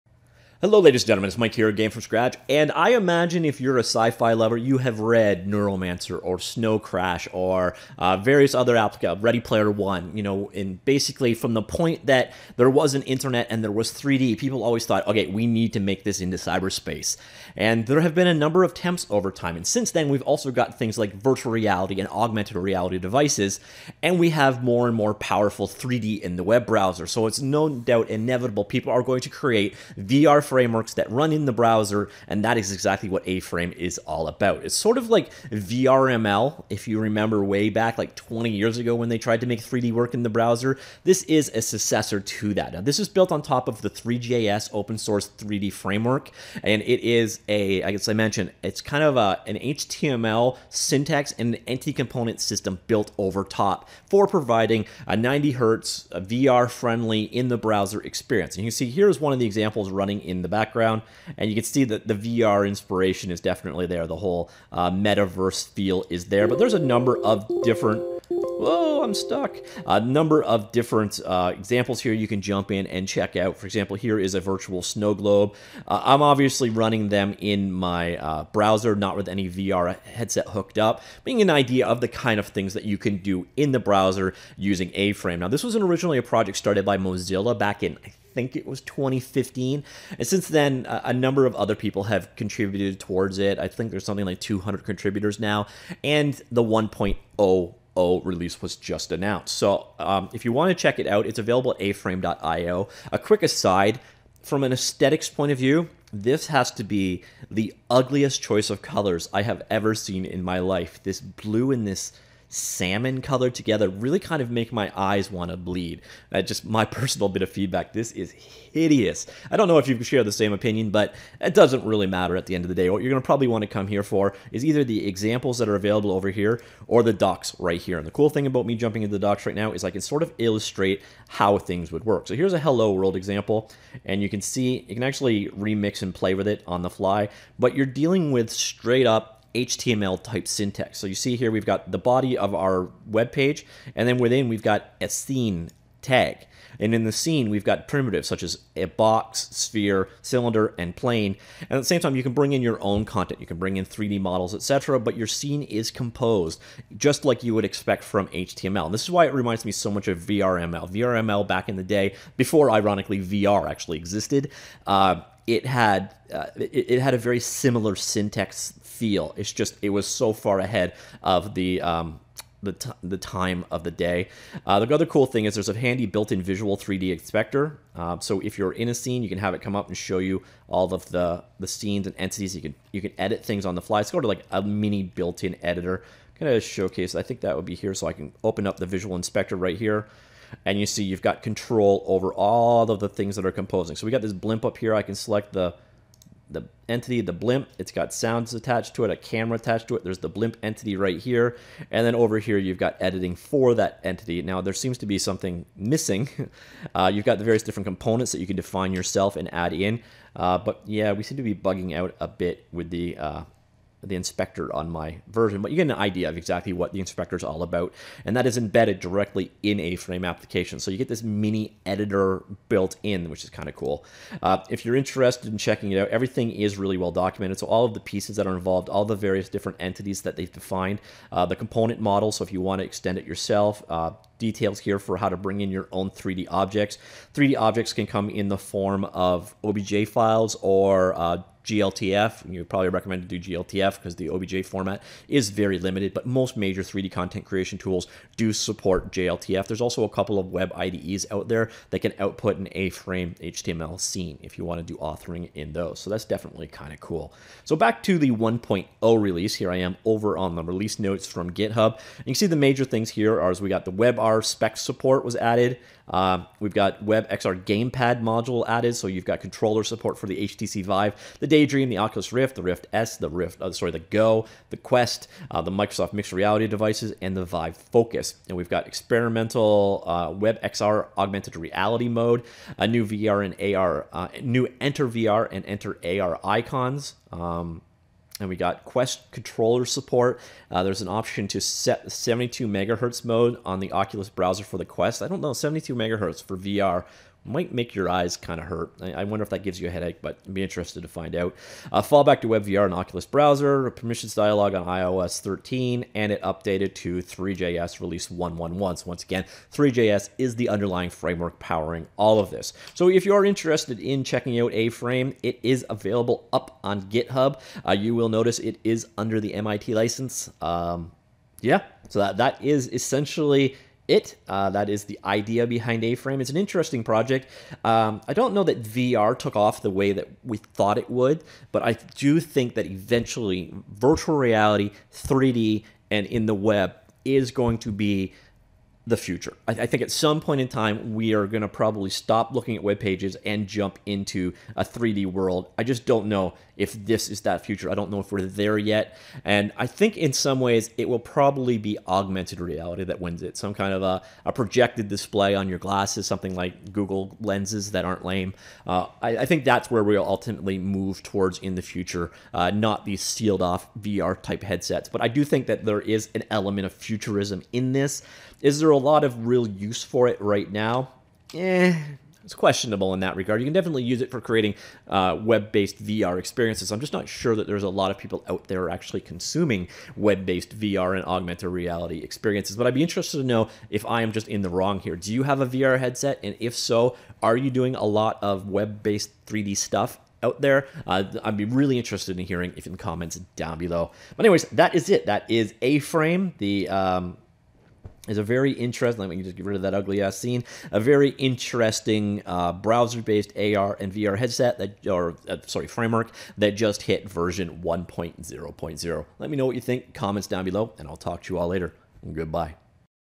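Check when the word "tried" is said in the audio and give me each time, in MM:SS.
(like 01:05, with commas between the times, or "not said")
00:39.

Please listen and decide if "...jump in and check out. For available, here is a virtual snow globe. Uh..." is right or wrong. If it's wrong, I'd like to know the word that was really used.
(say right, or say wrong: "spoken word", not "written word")
wrong: "example", not "available".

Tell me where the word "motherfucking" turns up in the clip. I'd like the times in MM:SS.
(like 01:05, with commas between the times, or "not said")
not said.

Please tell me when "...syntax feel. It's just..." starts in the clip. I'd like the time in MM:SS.
02:47.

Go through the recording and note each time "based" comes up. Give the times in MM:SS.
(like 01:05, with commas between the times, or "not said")
06:15, 06:20, 06:28, 06:43.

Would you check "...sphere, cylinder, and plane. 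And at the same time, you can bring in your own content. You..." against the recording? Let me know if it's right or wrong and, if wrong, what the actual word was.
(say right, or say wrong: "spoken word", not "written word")
right.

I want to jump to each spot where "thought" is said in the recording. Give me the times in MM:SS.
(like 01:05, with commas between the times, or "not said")
00:14, 05:30.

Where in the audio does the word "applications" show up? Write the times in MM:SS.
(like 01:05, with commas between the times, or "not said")
00:08, 03:40.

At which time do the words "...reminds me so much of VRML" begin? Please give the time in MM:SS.
02:39.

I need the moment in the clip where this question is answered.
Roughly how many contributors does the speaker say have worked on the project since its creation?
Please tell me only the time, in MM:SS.
01:34.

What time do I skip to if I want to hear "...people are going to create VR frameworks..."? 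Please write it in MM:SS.
00:28.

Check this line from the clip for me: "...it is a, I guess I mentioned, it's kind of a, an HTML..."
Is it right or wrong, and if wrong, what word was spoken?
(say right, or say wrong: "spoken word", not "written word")
right.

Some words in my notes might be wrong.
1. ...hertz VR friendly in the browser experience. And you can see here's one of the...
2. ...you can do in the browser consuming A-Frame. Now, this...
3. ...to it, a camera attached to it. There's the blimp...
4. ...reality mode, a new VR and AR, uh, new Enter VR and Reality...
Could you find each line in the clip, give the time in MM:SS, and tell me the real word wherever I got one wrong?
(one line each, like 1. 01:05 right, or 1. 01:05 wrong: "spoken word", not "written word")
1. 00:55 right
2. 01:22 wrong: "using", not "consuming"
3. 03:18 right
4. 04:41 wrong: "Enter", not "Reality".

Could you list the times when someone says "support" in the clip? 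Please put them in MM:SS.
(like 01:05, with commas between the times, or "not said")
04:08, 04:24, 04:29, 04:49.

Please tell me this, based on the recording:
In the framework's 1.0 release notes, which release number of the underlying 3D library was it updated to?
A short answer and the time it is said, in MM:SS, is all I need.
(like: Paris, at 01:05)
111, at 05:07.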